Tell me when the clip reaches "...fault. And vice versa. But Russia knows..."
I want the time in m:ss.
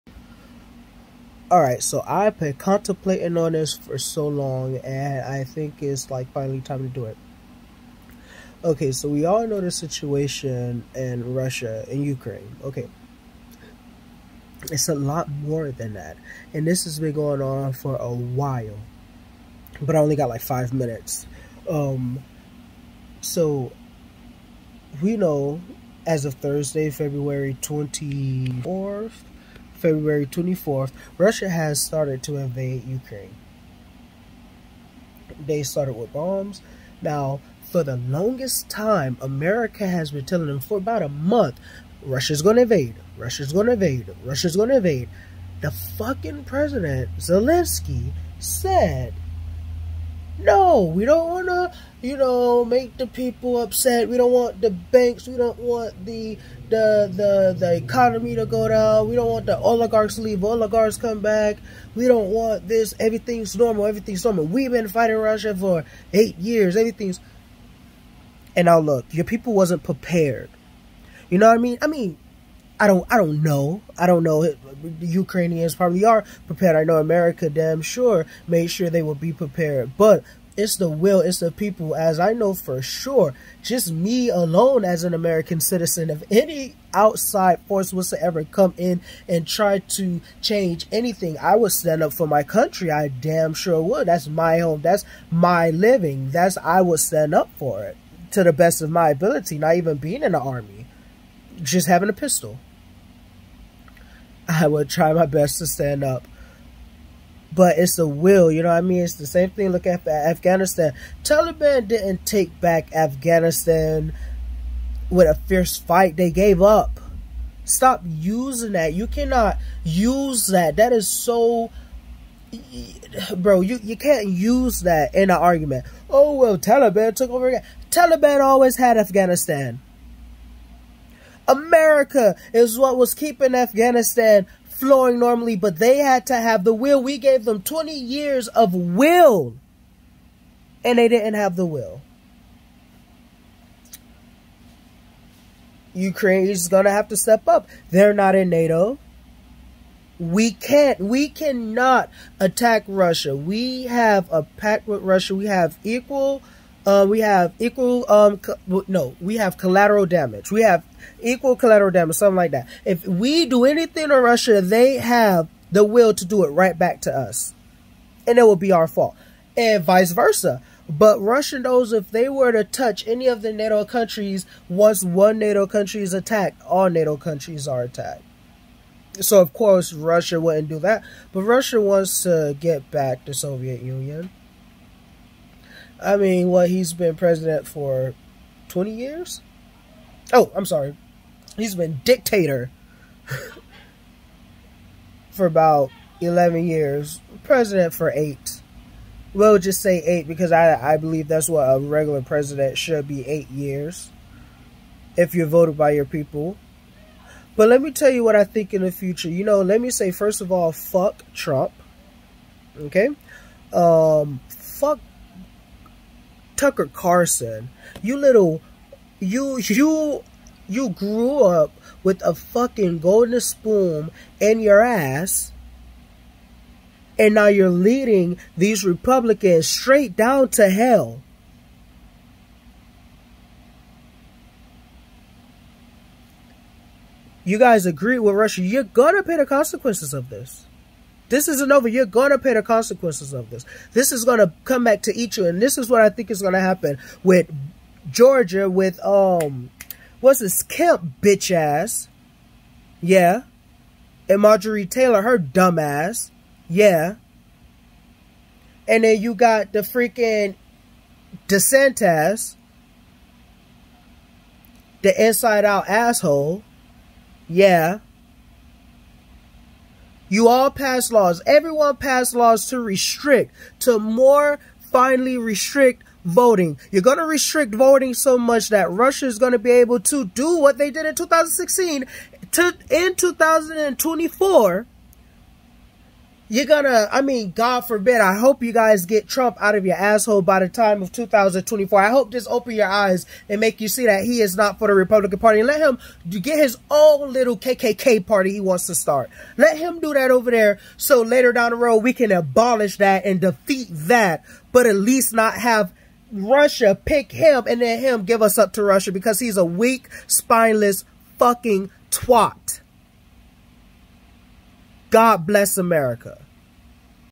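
2:48.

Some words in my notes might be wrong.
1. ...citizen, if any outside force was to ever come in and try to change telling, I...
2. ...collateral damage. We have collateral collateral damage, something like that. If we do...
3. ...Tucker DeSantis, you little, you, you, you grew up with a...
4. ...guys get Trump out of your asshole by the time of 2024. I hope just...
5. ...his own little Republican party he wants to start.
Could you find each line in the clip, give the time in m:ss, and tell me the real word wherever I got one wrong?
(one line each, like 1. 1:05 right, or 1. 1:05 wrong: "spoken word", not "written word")
1. 1:25 wrong: "anything", not "telling"
2. 2:39 wrong: "equal", not "collateral"
3. 3:36 wrong: "Carlson", not "DeSantis"
4. 4:48 right
5. 4:56 wrong: "KKK", not "Republican".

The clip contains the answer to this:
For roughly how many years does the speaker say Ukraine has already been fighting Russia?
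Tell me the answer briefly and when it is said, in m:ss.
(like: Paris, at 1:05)
8 years, at 1:06.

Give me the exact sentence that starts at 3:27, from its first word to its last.
But let me tell you what I think in the future.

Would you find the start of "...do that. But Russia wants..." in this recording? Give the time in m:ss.
3:00.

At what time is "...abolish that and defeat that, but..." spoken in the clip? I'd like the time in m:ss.
5:02.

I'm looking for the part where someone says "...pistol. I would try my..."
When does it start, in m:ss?
1:42.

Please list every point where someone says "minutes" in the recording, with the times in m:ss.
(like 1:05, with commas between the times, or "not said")
0:20.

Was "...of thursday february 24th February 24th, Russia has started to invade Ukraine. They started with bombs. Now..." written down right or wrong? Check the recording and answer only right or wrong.
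right.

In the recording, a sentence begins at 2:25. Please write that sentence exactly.
Ukraine is going to have to step up.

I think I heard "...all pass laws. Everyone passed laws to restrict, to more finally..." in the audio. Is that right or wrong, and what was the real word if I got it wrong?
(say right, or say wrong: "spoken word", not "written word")
right.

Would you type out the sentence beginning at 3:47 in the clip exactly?
And now you're leading these Republicans straight down to hell.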